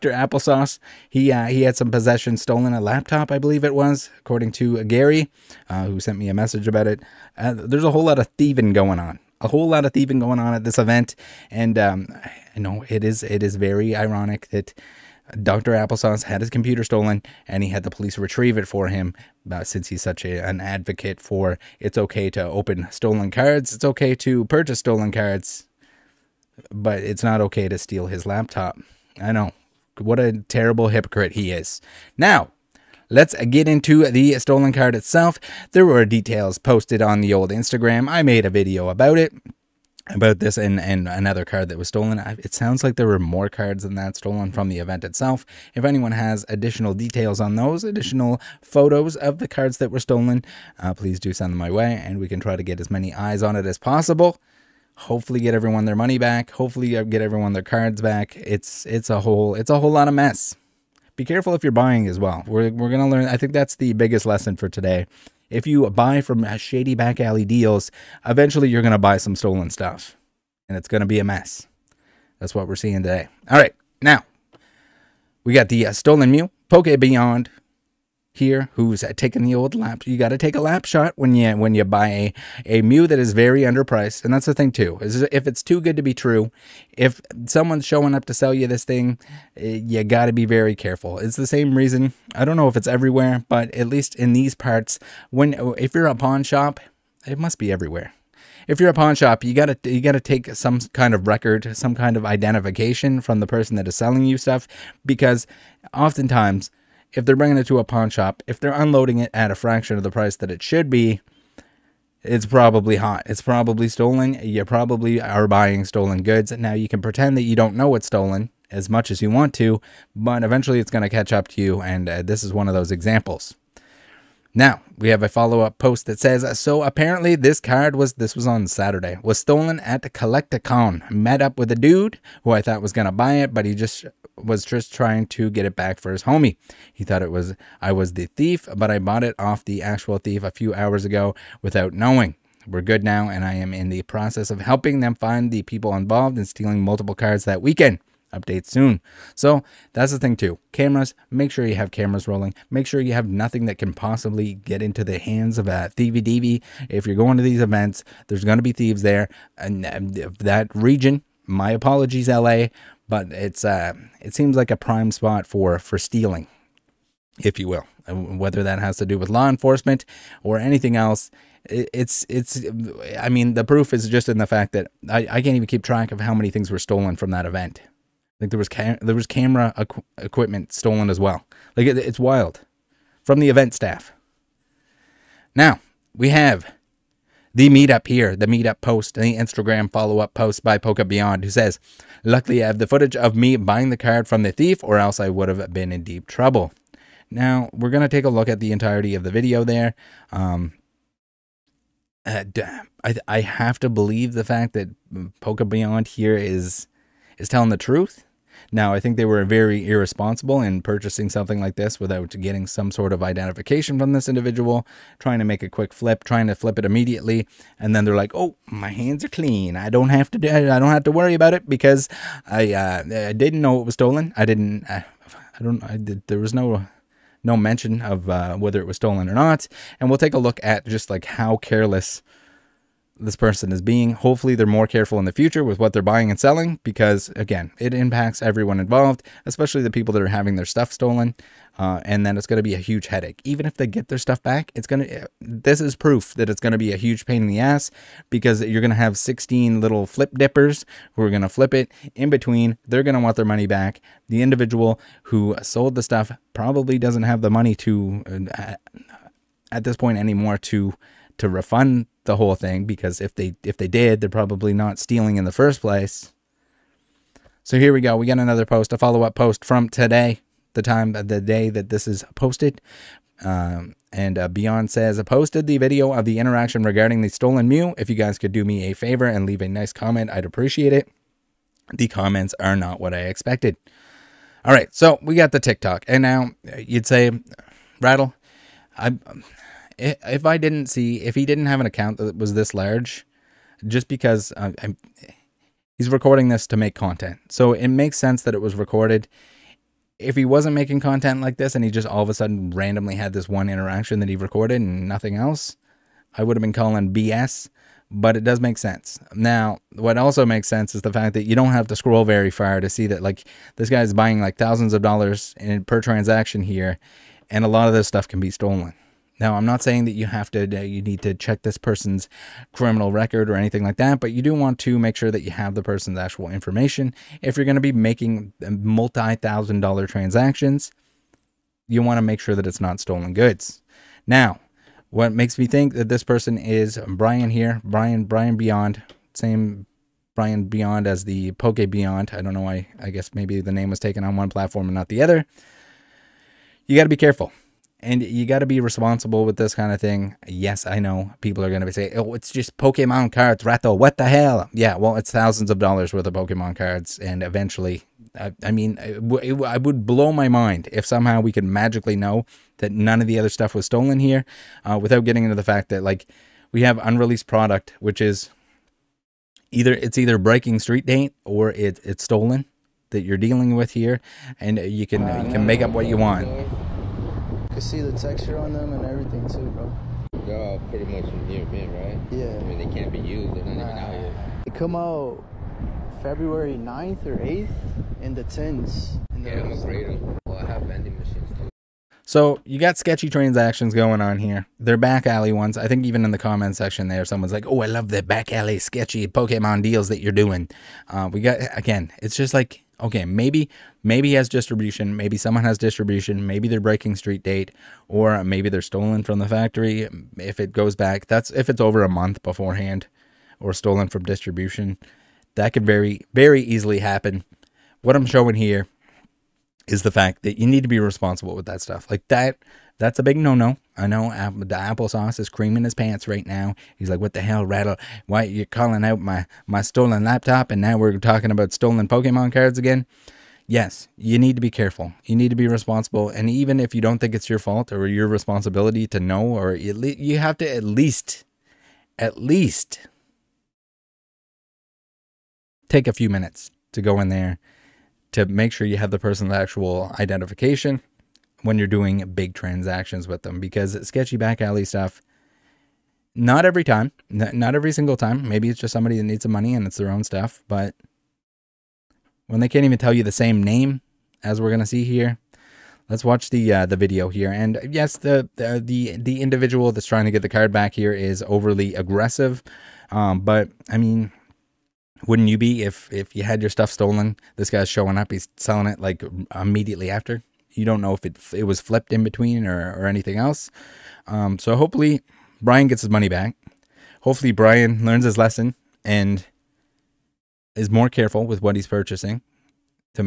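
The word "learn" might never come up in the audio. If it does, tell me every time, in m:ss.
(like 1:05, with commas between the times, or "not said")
1:03, 8:08.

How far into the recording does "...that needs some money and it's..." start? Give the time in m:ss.
7:39.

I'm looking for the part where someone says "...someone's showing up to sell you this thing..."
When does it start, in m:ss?
1:27.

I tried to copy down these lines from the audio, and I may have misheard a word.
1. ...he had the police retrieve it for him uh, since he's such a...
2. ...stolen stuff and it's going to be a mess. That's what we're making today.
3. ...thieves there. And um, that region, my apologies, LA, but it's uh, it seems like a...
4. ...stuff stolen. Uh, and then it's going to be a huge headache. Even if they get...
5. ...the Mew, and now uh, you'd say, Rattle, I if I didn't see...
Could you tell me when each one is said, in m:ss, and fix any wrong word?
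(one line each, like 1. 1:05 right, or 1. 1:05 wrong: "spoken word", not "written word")
1. 0:17 right
2. 1:09 wrong: "seeing", not "making"
3. 2:38 right
4. 4:00 right
5. 4:45 wrong: "TikTok", not "Mew".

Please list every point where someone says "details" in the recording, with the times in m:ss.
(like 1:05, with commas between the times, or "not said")
0:36, 0:46.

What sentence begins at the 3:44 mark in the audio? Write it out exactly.
I didn't I, uh, I don't I did, there was no no mention of uh, whether it was stolen or not.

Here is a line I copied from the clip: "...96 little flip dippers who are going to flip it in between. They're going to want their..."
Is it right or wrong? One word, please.
wrong.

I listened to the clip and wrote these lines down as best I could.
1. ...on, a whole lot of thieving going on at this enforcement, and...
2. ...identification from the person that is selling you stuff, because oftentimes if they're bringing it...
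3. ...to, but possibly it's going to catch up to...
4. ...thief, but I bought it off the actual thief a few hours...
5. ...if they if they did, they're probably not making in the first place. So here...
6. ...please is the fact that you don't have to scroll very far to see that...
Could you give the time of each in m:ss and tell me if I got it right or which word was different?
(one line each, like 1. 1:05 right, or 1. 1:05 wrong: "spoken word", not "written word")
1. 0:08 wrong: "event", not "enforcement"
2. 1:42 right
3. 1:59 wrong: "eventually", not "possibly"
4. 2:18 right
5. 4:23 wrong: "stealing", not "making"
6. 5:10 wrong: "sense", not "please".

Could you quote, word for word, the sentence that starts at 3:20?
Um, uh, I, I have to believe the fact that Poke Beyond here is is telling the truth.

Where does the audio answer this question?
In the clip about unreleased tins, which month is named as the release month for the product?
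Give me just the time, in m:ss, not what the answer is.
6:26.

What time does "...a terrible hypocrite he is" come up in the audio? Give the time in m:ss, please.
0:30.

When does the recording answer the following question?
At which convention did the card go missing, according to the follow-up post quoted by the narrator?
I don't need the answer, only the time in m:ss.
2:10.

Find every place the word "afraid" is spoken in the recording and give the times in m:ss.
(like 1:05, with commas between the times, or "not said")
6:29.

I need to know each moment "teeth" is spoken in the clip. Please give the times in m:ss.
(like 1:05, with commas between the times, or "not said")
not said.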